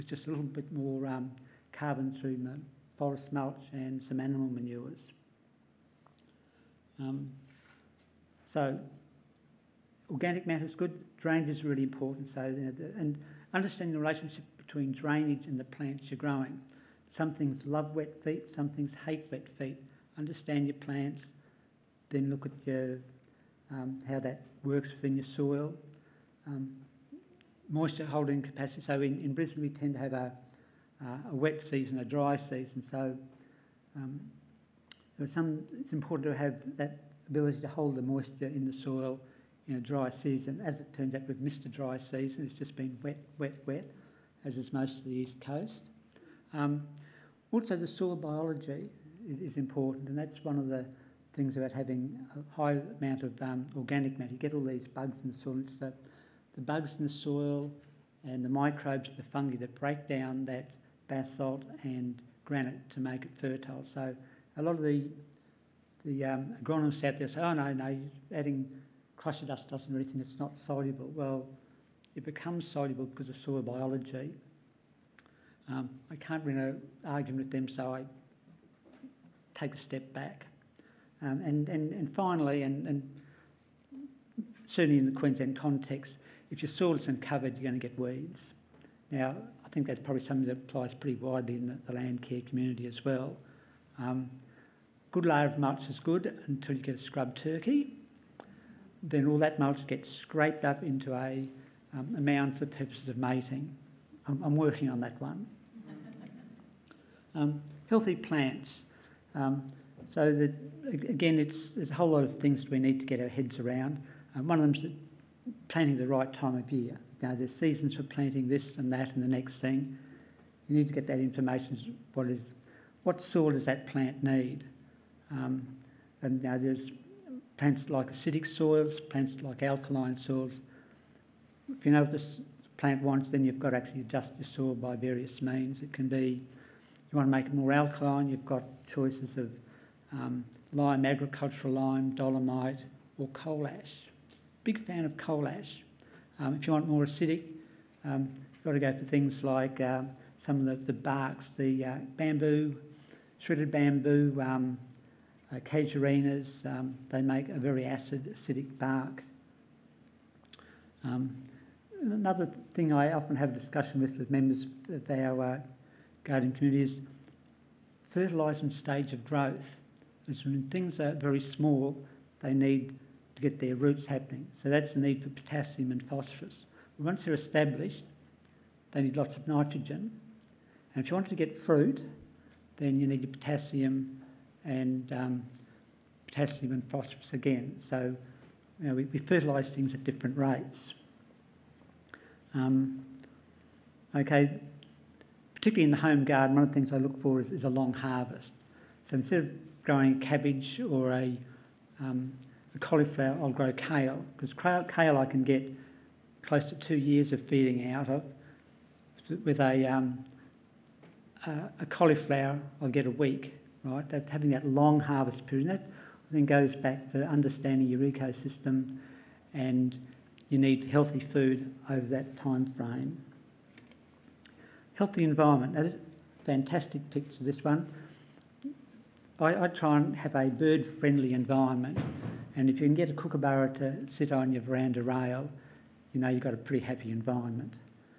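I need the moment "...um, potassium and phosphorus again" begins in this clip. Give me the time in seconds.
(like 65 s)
185 s.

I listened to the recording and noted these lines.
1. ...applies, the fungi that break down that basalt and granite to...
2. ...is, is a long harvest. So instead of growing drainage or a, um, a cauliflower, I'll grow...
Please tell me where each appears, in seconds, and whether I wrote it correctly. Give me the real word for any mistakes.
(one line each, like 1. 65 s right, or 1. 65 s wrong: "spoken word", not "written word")
1. 58 s wrong: "microbes", not "applies"
2. 197 s wrong: "cabbage", not "drainage".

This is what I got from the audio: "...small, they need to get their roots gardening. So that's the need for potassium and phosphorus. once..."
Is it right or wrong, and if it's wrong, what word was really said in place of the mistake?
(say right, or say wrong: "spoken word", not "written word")
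wrong: "happening", not "gardening".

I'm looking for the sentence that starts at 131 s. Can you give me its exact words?
If you know what the plant wants, then you've got to actually adjust your soil by various means.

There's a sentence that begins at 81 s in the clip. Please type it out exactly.
Um, and, and, and finally, and, and certainly in the Queensland context, if your soil is covered, you're going to get weeds.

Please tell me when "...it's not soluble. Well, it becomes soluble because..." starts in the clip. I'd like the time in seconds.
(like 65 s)
70 s.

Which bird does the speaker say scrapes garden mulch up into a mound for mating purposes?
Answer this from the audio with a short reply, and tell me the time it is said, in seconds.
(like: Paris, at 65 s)
scrub turkey, at 96 s.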